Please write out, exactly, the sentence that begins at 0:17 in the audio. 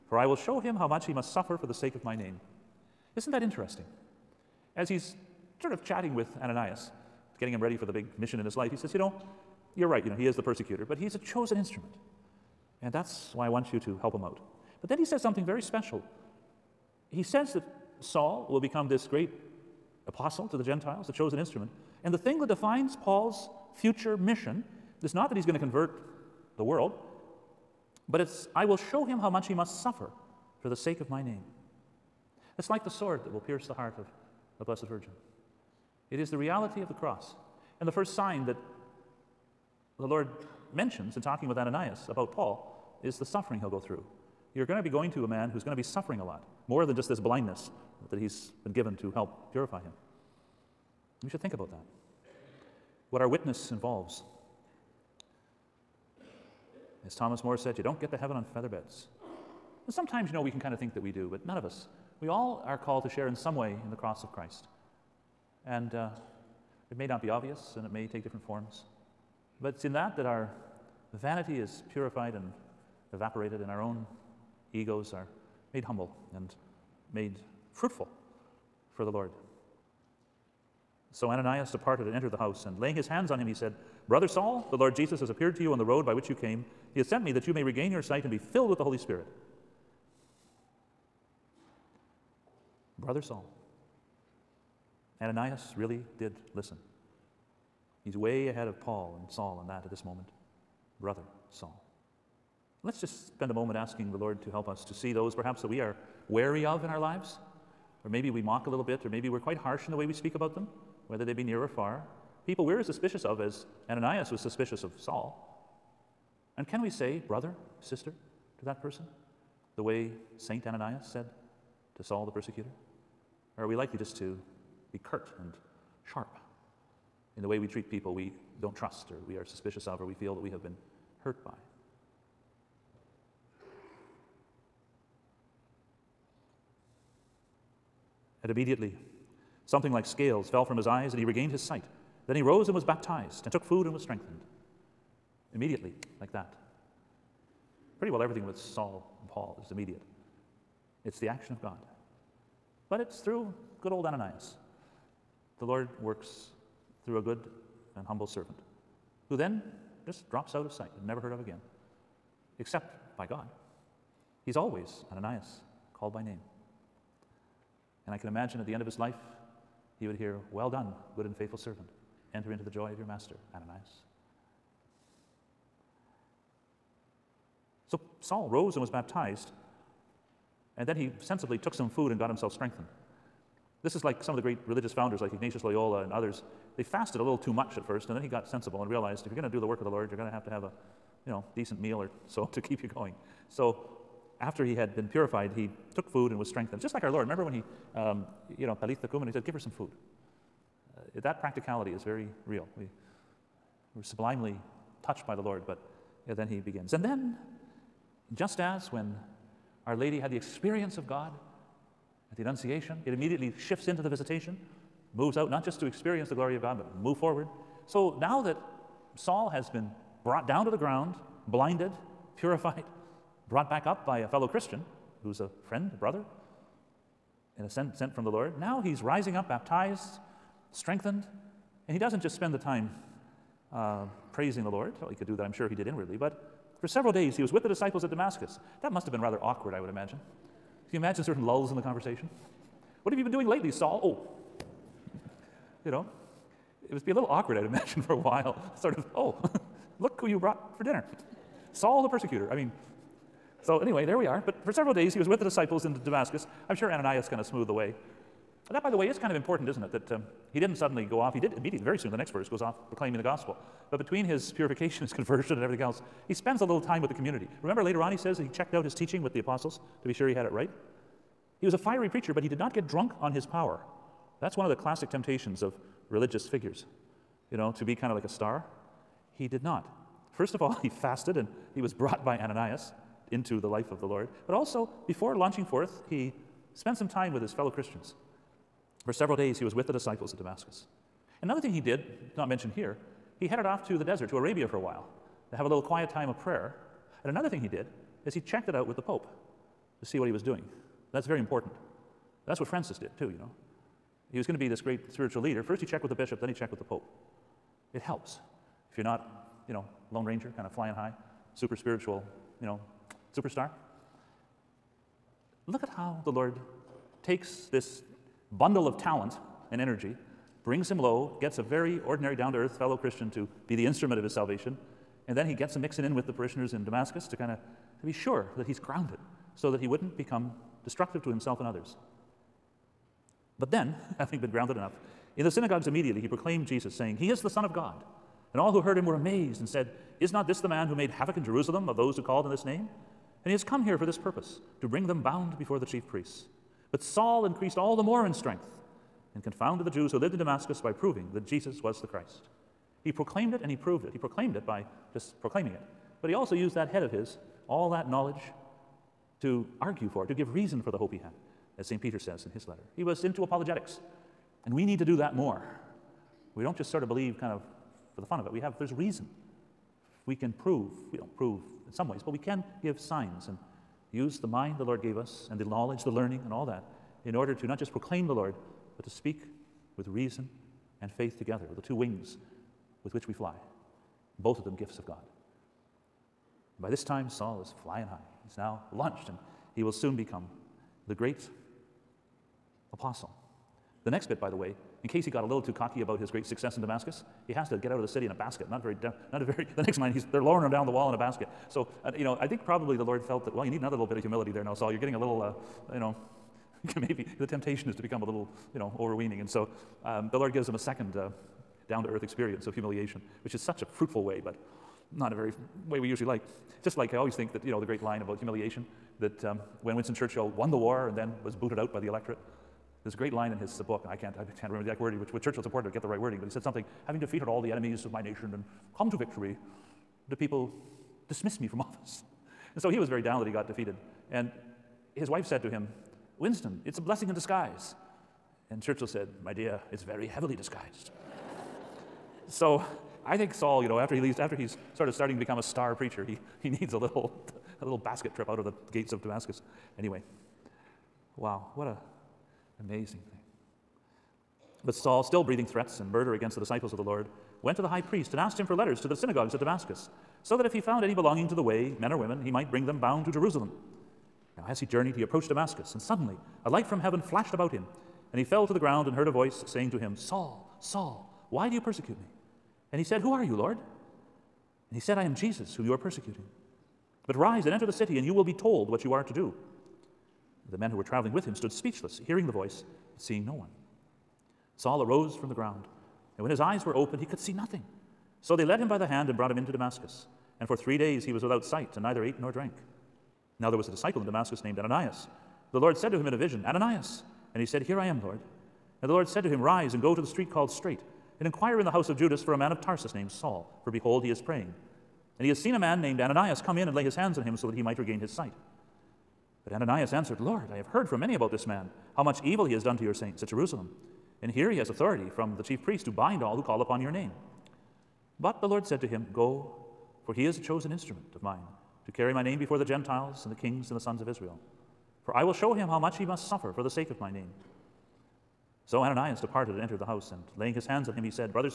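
He says that Saul will become this great apostle to the Gentiles, the chosen instrument.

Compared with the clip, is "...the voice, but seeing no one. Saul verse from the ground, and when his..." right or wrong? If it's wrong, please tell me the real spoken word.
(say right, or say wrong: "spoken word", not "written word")
wrong: "arose", not "verse".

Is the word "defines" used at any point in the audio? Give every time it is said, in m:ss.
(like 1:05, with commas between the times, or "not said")
0:22.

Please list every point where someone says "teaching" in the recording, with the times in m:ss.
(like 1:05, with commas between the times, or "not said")
4:28.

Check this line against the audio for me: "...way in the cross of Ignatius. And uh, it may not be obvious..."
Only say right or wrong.
wrong.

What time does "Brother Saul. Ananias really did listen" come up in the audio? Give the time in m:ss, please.
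1:32.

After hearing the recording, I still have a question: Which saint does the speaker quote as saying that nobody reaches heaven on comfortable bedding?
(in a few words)
Thomas More.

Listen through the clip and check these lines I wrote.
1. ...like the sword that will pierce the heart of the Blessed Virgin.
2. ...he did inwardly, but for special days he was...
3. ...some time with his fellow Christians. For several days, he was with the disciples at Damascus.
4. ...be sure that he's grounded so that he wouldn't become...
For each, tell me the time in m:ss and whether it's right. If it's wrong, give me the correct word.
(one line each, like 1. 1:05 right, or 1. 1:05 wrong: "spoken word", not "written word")
1. 0:32 right
2. 3:55 wrong: "several", not "special"
3. 4:46 right
4. 5:28 right.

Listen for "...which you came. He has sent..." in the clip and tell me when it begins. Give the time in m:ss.
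1:26.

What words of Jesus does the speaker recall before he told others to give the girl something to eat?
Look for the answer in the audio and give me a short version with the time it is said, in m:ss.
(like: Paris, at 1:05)
Talitha Kum, at 3:18.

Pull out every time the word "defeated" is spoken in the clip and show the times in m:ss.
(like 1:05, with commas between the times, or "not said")
7:07, 7:13.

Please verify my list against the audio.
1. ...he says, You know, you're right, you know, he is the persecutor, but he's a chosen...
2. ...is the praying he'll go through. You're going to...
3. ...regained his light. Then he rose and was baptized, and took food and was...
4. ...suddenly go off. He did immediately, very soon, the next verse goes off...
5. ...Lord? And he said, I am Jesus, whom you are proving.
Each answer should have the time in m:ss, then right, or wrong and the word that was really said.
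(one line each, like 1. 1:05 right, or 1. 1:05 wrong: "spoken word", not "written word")
1. 0:08 right
2. 0:43 wrong: "suffering", not "praying"
3. 2:21 wrong: "sight", not "light"
4. 4:20 right
5. 7:53 wrong: "persecuting", not "proving".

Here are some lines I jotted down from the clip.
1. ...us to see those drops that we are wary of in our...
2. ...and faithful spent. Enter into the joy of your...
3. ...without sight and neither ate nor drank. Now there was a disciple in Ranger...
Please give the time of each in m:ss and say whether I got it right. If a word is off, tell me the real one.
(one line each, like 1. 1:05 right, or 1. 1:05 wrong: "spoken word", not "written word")
1. 1:44 wrong: "perhaps", not "drops"
2. 2:51 wrong: "servant", not "spent"
3. 8:11 wrong: "Damascus", not "Ranger".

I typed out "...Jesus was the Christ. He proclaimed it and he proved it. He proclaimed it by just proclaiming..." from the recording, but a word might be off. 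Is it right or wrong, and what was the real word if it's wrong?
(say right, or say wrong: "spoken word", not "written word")
right.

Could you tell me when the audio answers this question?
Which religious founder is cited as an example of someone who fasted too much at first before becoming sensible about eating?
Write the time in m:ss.
3:05.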